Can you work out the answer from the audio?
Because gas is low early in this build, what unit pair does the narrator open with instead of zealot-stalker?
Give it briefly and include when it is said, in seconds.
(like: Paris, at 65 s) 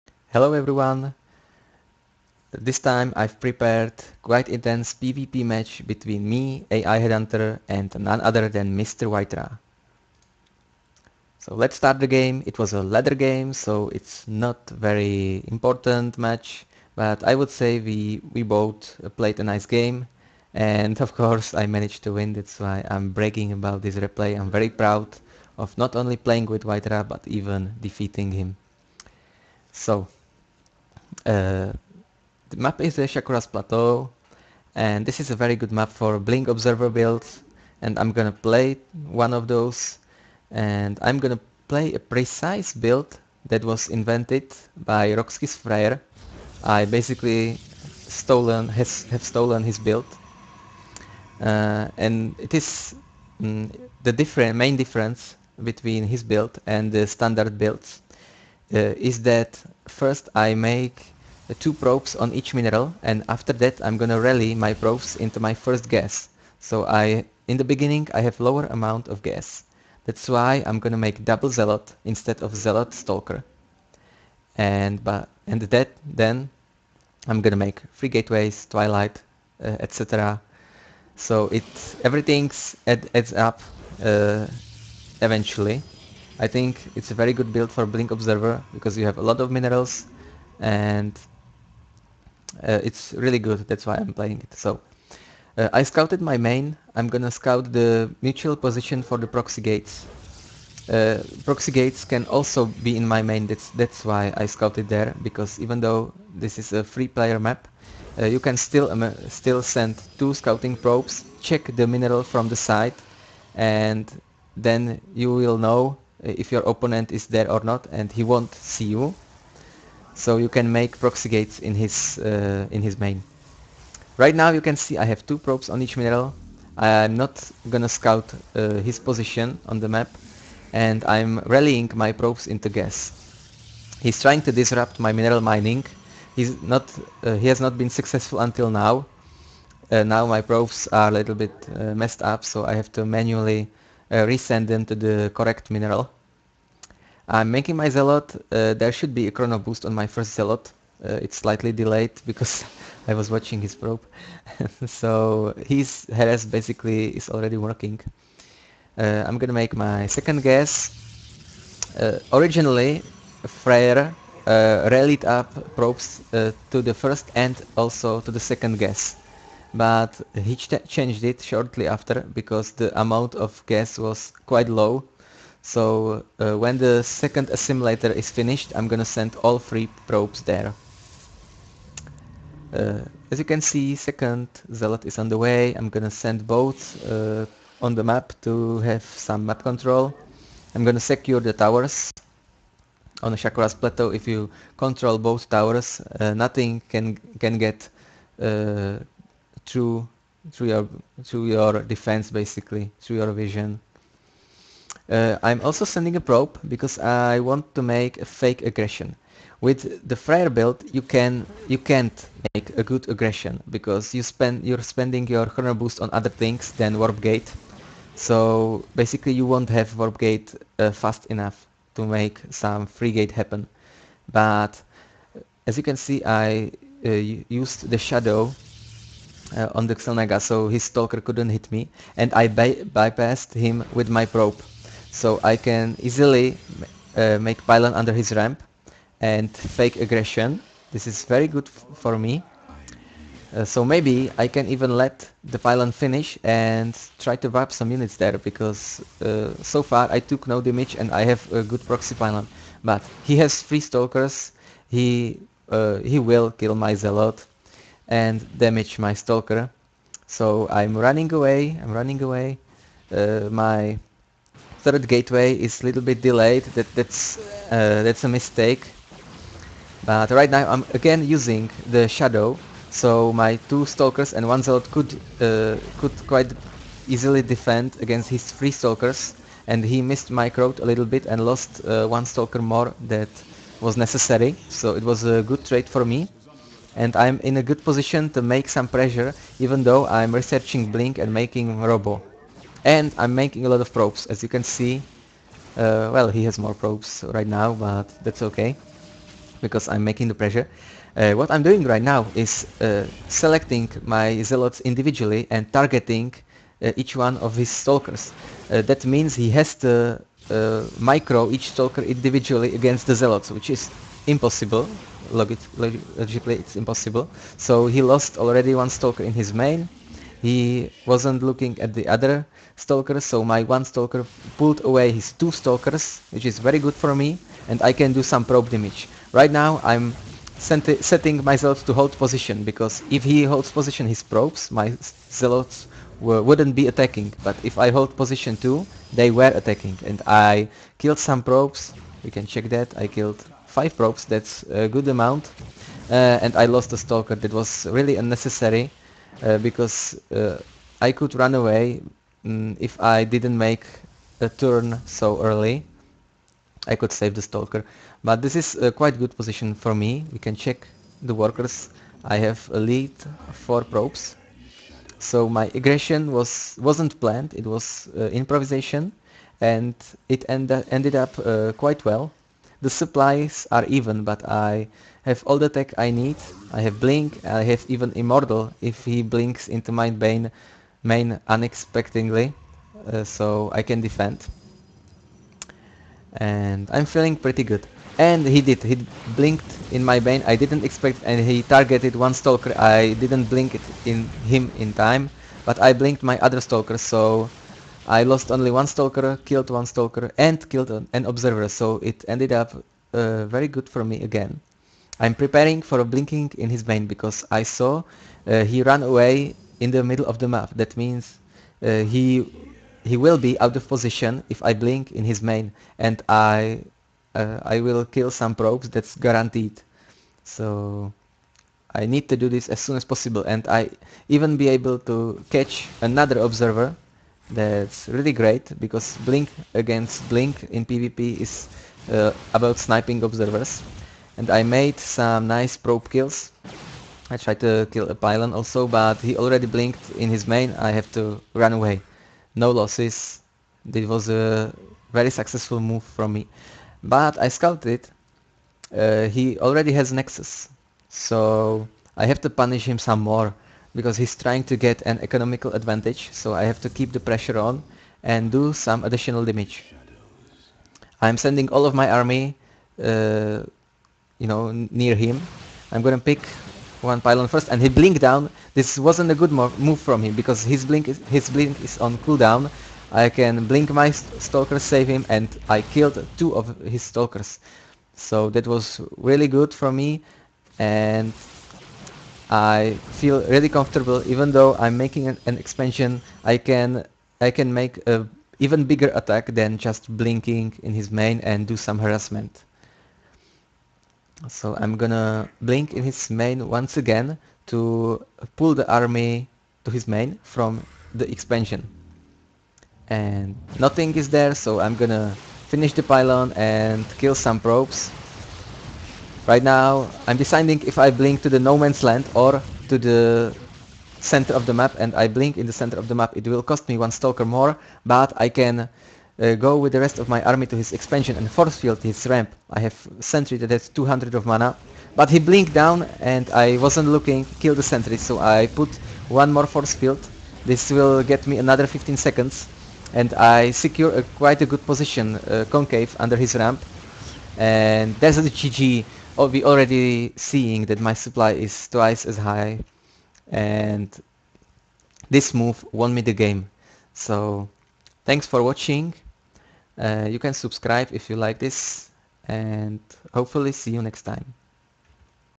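Double zealot, at 71 s.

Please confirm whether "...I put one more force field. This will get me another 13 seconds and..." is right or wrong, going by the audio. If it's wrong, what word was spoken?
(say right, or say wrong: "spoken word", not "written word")
wrong: "15", not "13".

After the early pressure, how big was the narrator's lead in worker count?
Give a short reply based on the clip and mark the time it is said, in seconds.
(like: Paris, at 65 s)
4 probes, at 363 s.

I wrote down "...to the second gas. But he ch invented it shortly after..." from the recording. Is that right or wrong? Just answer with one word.
wrong.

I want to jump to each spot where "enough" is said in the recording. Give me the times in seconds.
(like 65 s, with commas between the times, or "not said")
221 s.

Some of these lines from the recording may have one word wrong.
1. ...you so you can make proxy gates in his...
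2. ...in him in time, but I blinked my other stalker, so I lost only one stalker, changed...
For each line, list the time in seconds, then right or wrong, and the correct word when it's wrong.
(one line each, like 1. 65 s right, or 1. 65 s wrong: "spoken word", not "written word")
1. 118 s right
2. 394 s wrong: "killed", not "changed".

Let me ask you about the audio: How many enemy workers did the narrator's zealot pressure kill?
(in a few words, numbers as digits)
5.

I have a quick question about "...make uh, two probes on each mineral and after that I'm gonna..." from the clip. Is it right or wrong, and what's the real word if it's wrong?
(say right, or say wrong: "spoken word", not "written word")
right.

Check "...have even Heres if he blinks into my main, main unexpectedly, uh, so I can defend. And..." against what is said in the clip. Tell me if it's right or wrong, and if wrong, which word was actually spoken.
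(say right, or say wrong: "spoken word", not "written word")
wrong: "Immortal", not "Heres".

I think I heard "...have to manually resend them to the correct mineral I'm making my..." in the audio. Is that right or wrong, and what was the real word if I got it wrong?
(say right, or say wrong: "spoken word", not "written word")
right.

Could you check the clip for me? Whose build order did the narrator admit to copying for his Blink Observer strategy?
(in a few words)
Roxkis Freyr.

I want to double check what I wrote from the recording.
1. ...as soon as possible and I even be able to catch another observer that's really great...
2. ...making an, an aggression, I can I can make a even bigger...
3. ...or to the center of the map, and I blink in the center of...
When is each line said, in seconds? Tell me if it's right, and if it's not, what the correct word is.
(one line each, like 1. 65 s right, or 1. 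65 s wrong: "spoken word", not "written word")
1. 422 s right
2. 484 s wrong: "expansion", not "aggression"
3. 512 s right.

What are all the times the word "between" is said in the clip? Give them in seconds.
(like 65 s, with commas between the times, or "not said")
5 s, 55 s.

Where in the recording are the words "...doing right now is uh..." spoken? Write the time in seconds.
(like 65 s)
301 s.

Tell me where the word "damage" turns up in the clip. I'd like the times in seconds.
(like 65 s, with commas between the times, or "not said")
250 s, 258 s, 328 s, 459 s.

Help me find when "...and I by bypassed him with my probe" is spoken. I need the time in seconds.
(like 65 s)
232 s.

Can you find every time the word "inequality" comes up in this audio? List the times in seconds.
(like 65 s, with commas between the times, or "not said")
not said.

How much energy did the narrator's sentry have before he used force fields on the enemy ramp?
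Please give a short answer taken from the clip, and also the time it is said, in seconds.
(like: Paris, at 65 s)
200, at 523 s.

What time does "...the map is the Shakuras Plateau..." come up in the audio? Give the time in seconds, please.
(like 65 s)
32 s.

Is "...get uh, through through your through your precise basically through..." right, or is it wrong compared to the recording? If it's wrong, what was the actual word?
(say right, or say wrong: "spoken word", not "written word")
wrong: "defense", not "precise".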